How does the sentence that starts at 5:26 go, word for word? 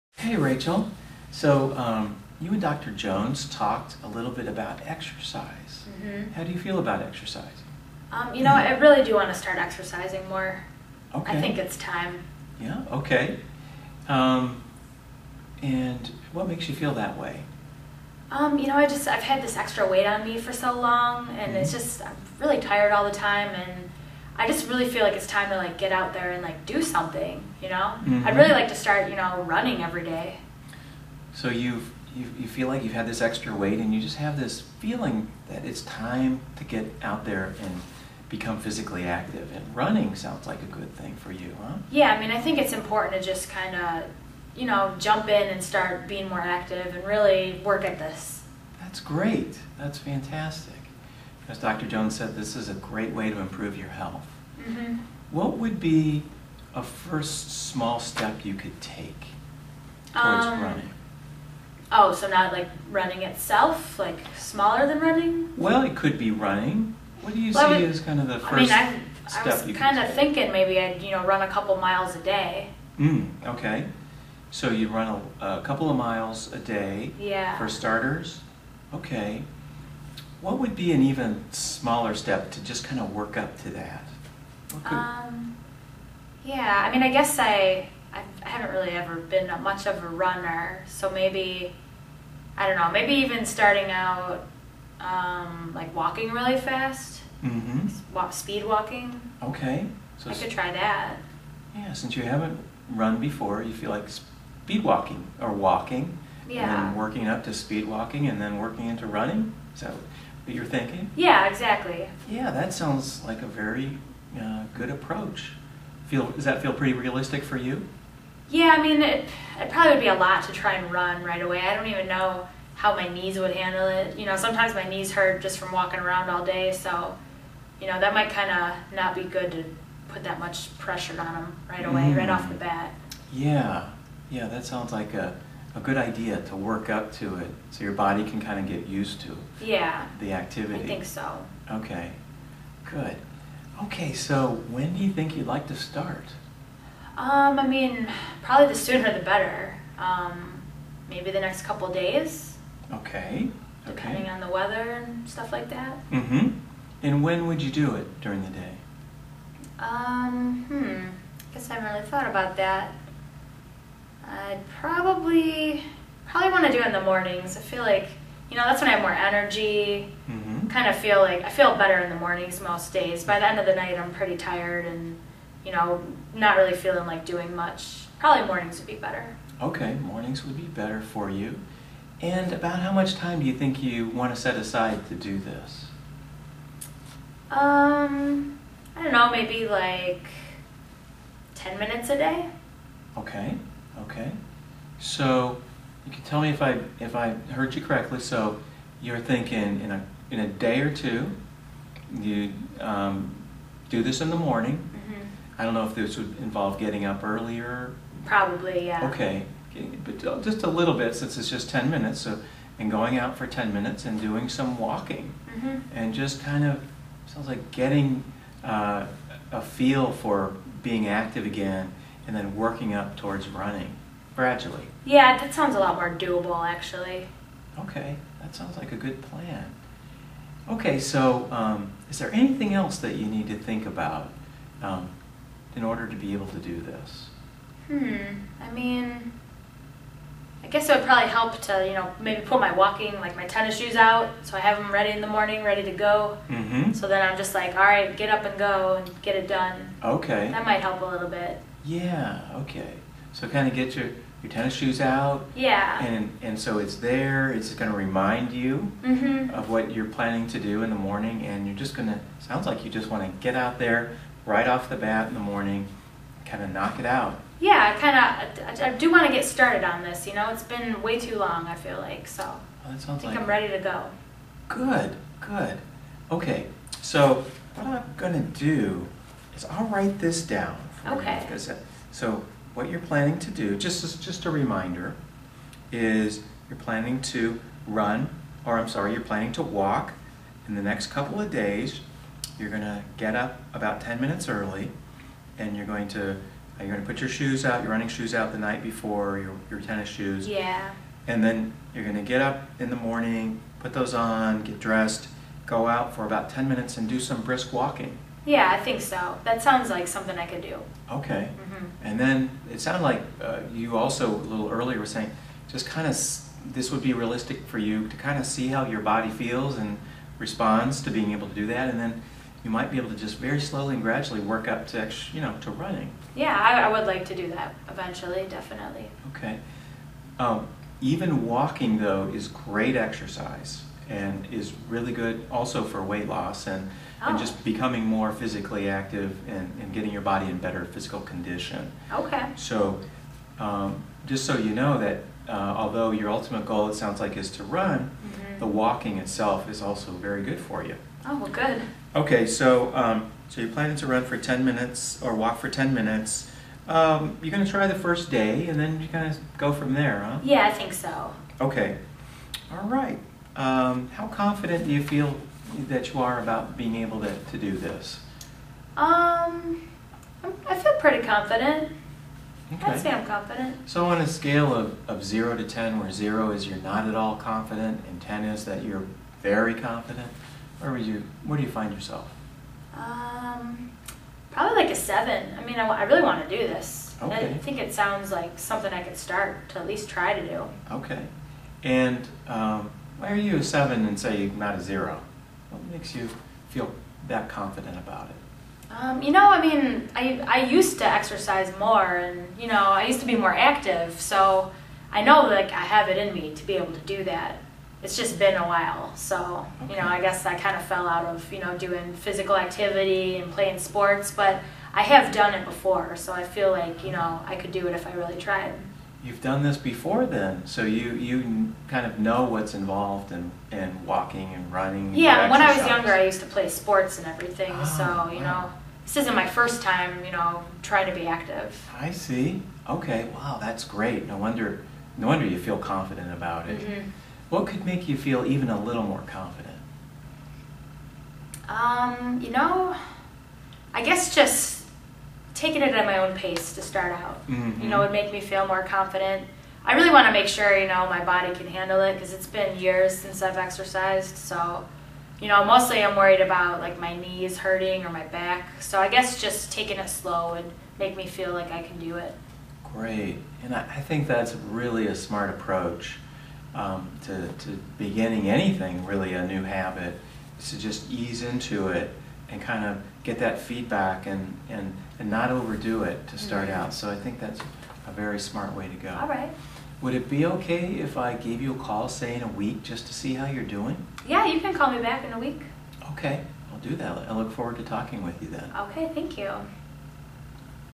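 Yeah, I, I would like to do that eventually, definitely.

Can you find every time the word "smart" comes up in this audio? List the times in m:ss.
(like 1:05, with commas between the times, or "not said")
7:45, 7:58.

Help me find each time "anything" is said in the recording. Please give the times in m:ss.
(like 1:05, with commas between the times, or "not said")
3:52, 7:48.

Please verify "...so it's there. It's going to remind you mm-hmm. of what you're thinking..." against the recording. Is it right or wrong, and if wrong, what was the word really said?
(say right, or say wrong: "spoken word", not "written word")
wrong: "planning", not "thinking".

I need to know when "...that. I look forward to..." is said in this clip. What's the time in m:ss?
8:07.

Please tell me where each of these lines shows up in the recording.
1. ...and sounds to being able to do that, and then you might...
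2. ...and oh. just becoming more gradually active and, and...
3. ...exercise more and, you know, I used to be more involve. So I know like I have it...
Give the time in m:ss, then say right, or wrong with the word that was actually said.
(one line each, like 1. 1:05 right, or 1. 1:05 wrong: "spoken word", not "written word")
1. 5:19 wrong: "responds", not "sounds"
2. 5:37 wrong: "physically", not "gradually"
3. 6:41 wrong: "active", not "involve".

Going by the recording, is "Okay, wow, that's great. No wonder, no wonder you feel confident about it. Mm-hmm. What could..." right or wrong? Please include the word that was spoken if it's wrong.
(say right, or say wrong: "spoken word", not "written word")
right.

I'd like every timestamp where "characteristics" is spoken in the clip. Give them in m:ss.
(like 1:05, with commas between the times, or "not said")
not said.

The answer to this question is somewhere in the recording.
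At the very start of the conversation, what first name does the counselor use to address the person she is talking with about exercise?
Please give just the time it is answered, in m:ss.
0:00.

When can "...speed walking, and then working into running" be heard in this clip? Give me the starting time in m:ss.
1:47.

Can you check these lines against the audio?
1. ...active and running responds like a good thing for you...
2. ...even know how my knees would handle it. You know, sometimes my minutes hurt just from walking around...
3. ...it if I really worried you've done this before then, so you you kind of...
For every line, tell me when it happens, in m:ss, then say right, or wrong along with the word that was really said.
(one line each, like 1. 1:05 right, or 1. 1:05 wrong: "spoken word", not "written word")
1. 0:39 wrong: "sounds", not "responds"
2. 2:01 wrong: "knees", not "minutes"
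3. 6:57 wrong: "tried", not "worried".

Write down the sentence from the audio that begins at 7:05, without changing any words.
And yeah, when I was younger, I used to play sports and everything, oh, so you wow.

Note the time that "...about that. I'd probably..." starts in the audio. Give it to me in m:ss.
2:42.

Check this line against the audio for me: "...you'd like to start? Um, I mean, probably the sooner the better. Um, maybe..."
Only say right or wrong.
right.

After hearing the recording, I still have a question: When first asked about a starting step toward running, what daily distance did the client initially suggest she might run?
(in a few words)
a couple miles.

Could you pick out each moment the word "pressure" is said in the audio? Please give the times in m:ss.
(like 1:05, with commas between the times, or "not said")
2:10.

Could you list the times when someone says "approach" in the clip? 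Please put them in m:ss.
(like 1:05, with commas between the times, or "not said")
1:54, 7:45.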